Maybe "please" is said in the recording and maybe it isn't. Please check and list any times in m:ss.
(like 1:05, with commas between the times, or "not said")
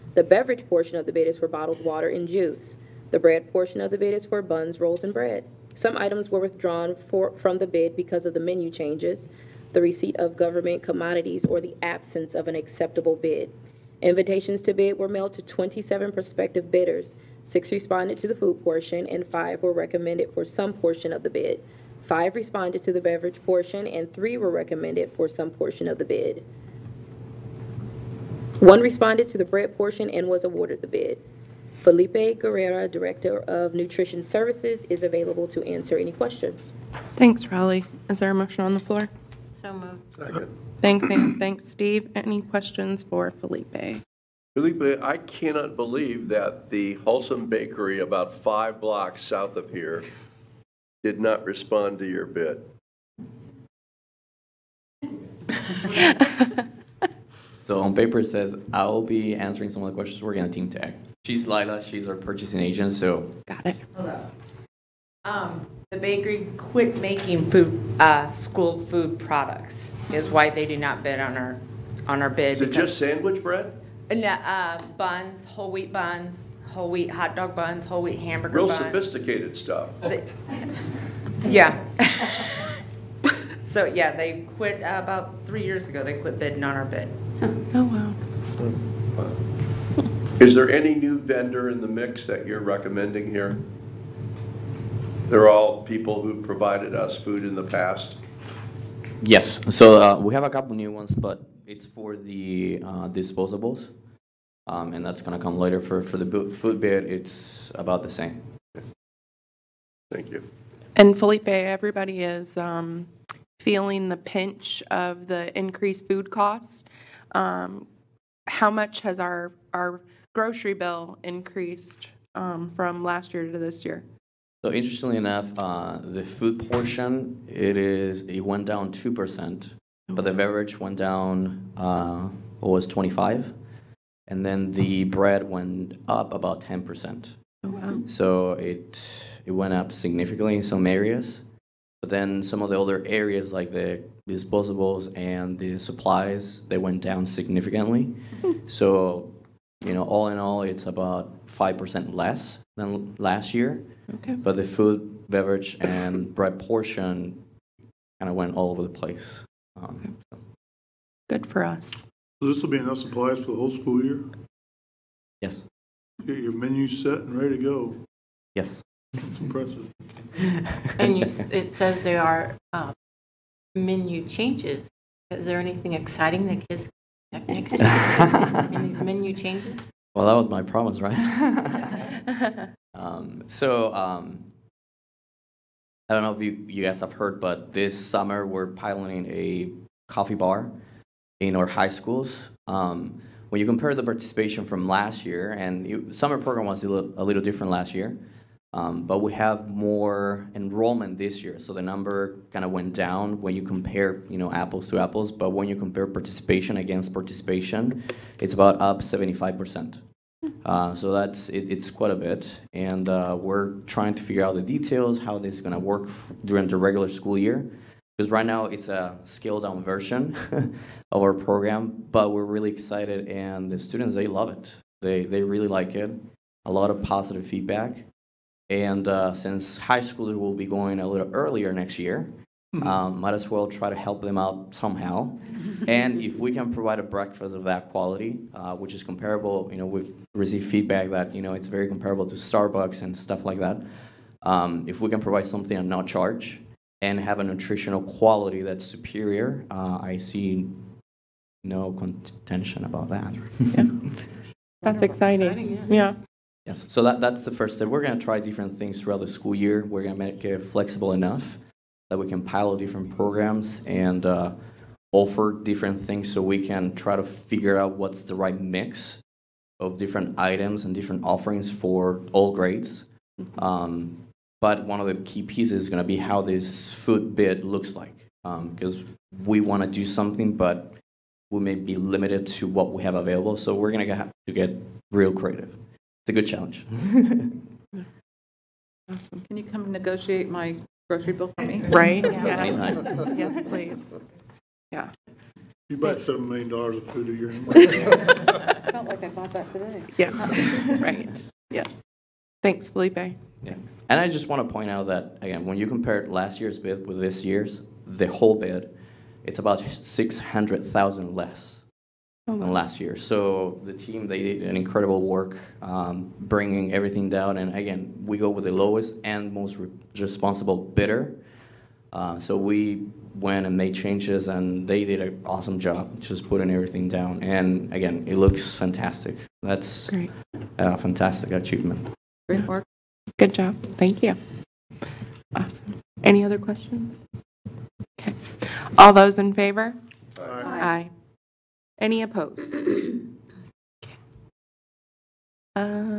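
4:53.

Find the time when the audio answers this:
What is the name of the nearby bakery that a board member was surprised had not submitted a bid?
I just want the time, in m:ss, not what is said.
0:46.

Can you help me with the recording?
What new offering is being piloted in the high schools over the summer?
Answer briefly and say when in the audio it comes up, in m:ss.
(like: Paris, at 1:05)
coffee bar, at 3:10.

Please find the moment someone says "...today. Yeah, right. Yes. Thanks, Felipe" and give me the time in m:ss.
4:59.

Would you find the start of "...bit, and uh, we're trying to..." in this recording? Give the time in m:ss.
3:32.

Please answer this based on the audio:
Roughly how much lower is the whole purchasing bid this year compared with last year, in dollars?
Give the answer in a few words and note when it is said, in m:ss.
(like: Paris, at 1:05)
$600,000, at 5:10.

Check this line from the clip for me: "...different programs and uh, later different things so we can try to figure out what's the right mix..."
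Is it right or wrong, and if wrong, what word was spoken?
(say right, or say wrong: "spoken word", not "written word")
wrong: "offer", not "later".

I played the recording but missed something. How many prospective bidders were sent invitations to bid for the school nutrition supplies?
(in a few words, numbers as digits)
27.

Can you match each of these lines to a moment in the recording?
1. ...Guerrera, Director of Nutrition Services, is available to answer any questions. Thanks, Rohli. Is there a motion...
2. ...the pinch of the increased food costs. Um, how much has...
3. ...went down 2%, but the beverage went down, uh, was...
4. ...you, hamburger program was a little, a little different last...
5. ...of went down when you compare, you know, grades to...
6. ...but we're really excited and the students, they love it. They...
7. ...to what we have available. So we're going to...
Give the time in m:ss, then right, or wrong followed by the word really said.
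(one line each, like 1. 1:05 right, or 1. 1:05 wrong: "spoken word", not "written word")
1. 0:32 right
2. 1:54 right
3. 2:08 right
4. 3:15 wrong: "summer", not "hamburger"
5. 3:22 wrong: "apples", not "grades"
6. 3:42 right
7. 4:42 right.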